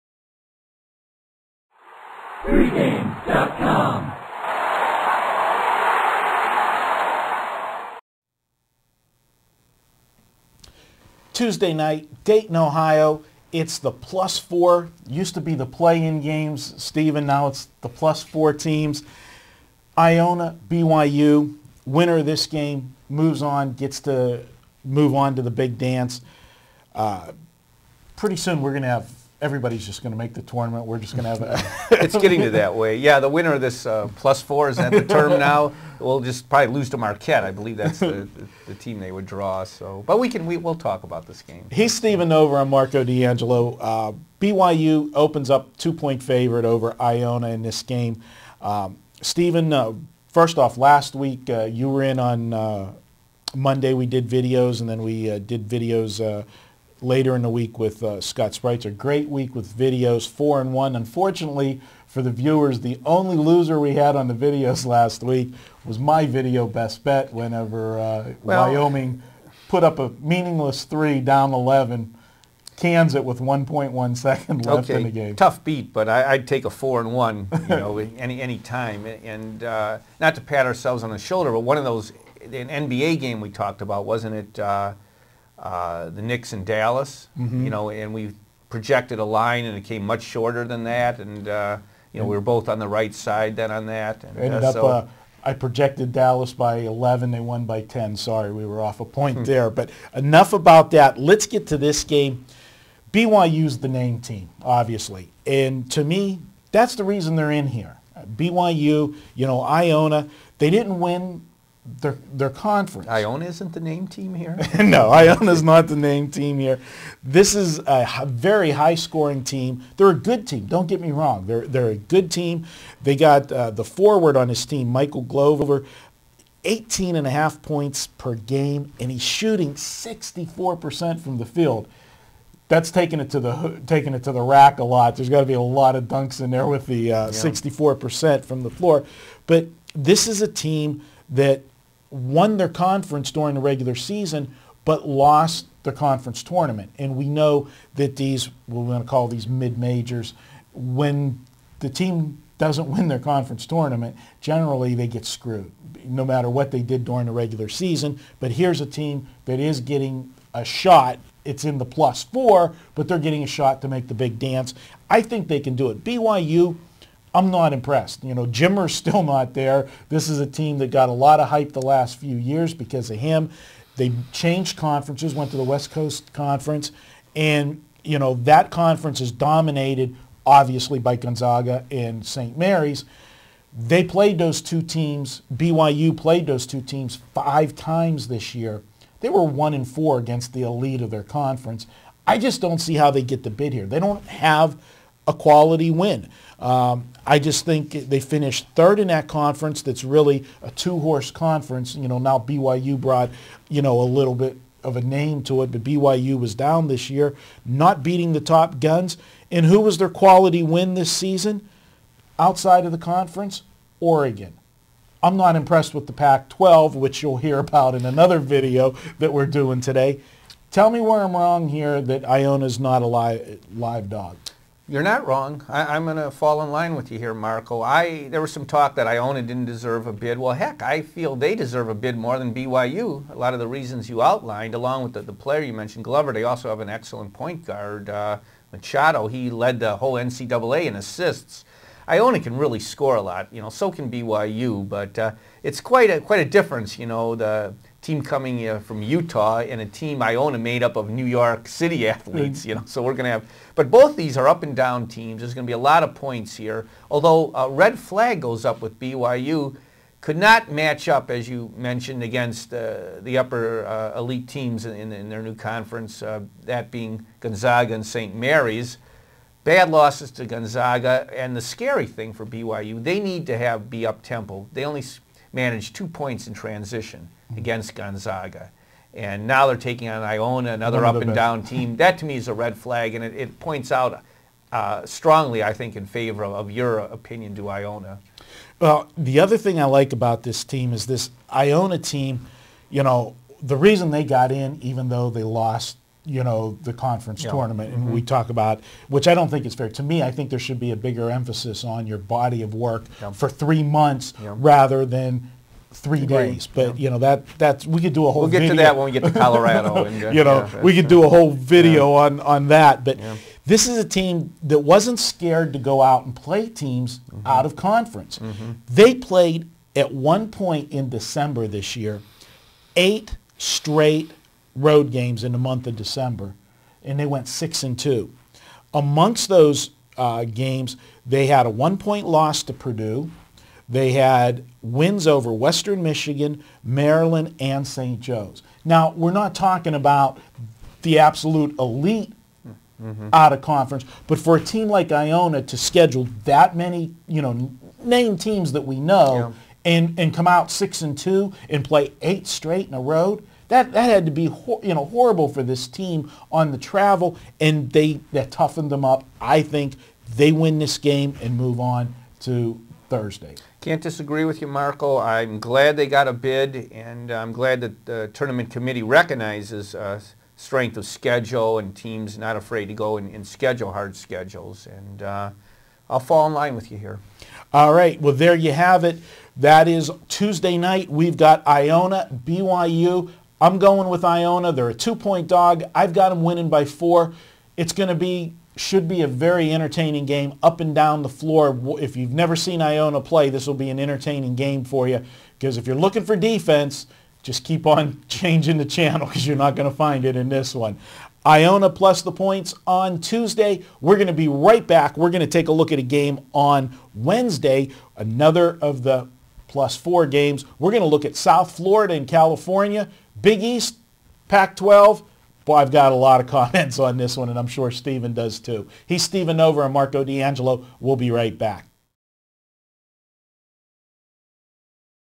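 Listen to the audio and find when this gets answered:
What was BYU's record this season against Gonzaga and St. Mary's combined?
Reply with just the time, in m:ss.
3:09.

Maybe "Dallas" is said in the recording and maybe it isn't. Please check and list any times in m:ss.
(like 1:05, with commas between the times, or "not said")
1:26, 1:36.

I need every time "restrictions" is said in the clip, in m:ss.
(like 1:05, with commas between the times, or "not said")
not said.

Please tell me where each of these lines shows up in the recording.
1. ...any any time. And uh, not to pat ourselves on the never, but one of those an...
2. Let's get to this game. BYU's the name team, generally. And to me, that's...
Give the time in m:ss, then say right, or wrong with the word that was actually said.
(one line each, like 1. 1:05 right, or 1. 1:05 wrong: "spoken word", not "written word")
1. 1:18 wrong: "shoulder", not "never"
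2. 1:41 wrong: "obviously", not "generally".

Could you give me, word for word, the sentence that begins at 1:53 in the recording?
Iona isn't the name team here?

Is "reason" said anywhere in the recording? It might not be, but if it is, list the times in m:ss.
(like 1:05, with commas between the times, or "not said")
1:47, 3:53, 4:53.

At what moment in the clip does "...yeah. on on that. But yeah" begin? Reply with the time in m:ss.
5:12.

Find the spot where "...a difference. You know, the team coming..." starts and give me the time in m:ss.
4:06.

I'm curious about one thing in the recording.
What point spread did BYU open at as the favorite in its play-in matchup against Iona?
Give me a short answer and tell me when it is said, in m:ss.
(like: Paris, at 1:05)
2 points, at 0:45.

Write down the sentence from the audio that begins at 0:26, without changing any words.
Uh, pretty soon we're going to have everybody's just going to make the tournament.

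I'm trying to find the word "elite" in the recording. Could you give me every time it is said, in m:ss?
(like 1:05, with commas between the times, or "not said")
3:10, 4:24, 5:41.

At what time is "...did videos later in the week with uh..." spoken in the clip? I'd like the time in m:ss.
0:55.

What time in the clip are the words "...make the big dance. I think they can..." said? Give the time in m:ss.
2:43.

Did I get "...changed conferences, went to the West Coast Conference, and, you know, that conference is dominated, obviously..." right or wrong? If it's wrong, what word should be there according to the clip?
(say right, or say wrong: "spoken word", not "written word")
right.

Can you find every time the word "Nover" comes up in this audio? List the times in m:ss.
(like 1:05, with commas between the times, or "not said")
0:42, 6:59.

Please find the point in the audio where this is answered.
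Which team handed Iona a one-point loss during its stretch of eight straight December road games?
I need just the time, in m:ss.
5:32.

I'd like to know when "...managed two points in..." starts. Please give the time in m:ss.
4:35.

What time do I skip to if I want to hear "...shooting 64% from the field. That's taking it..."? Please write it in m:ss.
2:09.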